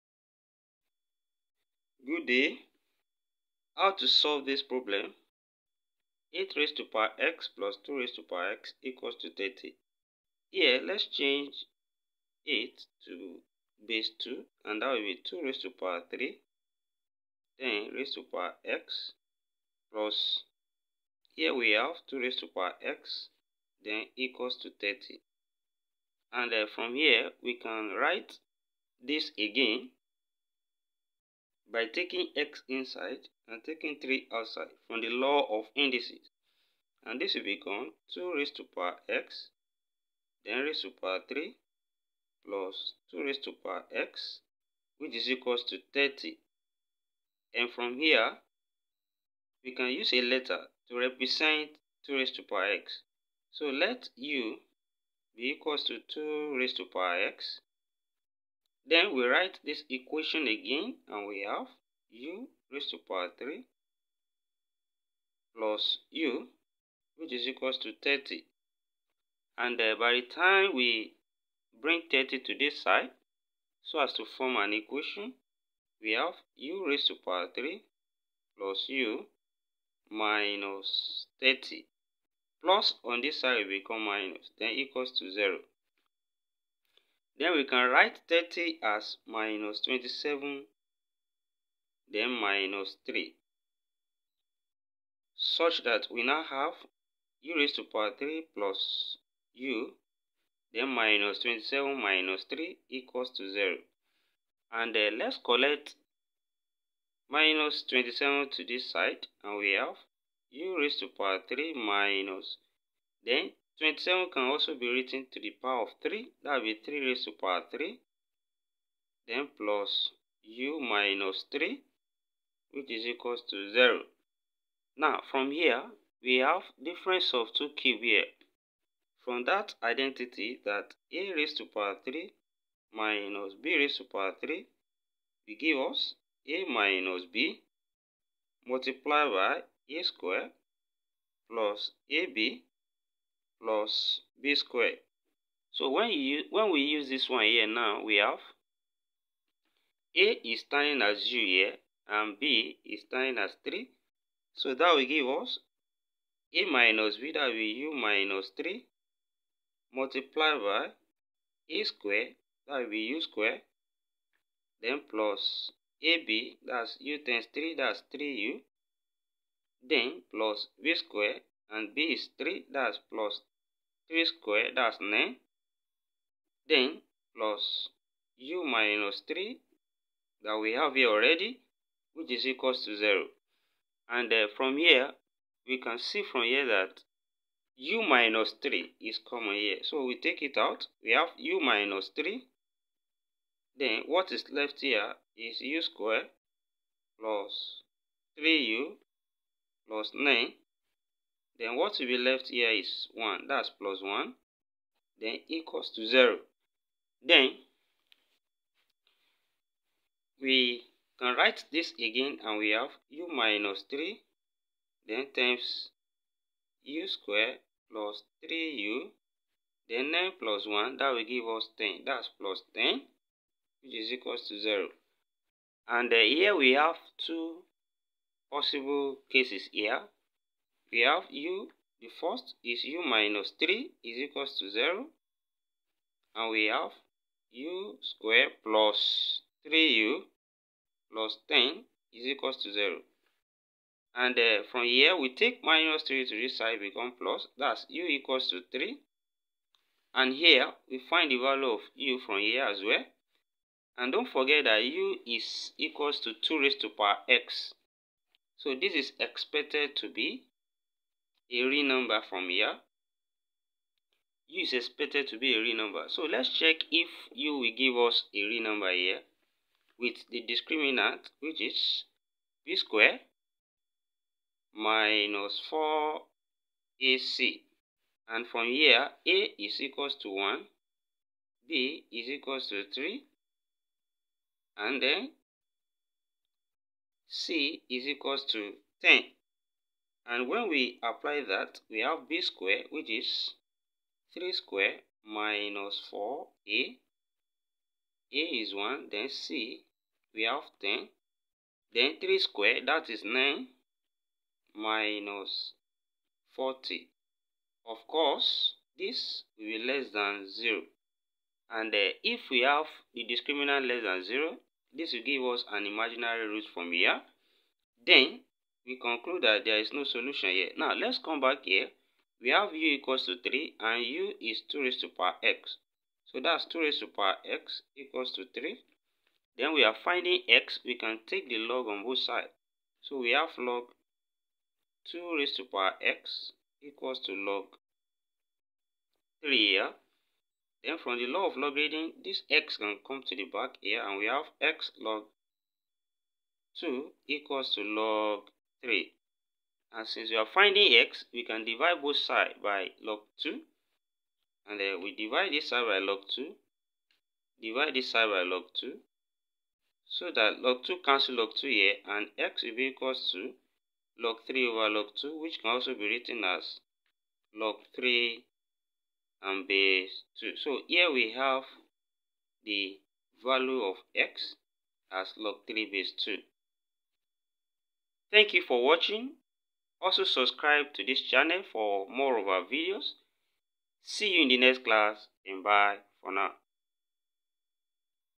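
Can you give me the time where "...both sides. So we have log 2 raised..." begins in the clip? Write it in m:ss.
5:32.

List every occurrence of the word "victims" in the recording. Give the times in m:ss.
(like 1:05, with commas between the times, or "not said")
not said.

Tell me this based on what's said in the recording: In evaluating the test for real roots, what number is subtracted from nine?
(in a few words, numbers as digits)
40.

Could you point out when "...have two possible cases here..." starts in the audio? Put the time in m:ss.
3:46.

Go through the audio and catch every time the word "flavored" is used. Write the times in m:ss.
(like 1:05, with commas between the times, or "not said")
not said.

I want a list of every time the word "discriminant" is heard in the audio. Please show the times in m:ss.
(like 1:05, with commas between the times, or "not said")
4:30, 5:13.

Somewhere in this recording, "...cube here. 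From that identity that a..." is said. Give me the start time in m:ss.
2:07.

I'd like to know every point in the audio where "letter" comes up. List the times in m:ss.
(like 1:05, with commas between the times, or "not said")
0:50.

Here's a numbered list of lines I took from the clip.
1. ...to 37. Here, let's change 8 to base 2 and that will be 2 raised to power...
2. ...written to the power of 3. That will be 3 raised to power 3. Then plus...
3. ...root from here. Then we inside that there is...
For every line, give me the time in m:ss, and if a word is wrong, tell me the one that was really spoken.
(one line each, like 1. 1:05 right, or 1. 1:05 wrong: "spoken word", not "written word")
1. 0:09 wrong: "30", not "37"
2. 1:54 right
3. 5:16 wrong: "conclude", not "inside".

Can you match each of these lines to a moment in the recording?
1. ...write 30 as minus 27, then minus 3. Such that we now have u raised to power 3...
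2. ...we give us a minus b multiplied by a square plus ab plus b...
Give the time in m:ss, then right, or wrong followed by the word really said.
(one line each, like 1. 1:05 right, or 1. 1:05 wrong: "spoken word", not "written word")
1. 1:27 right
2. 2:15 right.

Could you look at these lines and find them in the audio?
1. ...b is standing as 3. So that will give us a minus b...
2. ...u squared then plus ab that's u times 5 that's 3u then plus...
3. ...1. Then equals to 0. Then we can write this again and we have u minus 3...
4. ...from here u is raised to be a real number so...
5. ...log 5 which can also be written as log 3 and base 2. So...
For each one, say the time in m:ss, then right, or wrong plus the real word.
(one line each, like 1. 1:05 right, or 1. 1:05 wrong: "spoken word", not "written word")
1. 2:32 right
2. 2:43 wrong: "3", not "5"
3. 3:24 right
4. 4:22 wrong: "expected", not "raised"
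5. 6:04 wrong: "2", not "5".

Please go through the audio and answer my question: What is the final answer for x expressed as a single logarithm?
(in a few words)
log base 2 of 3.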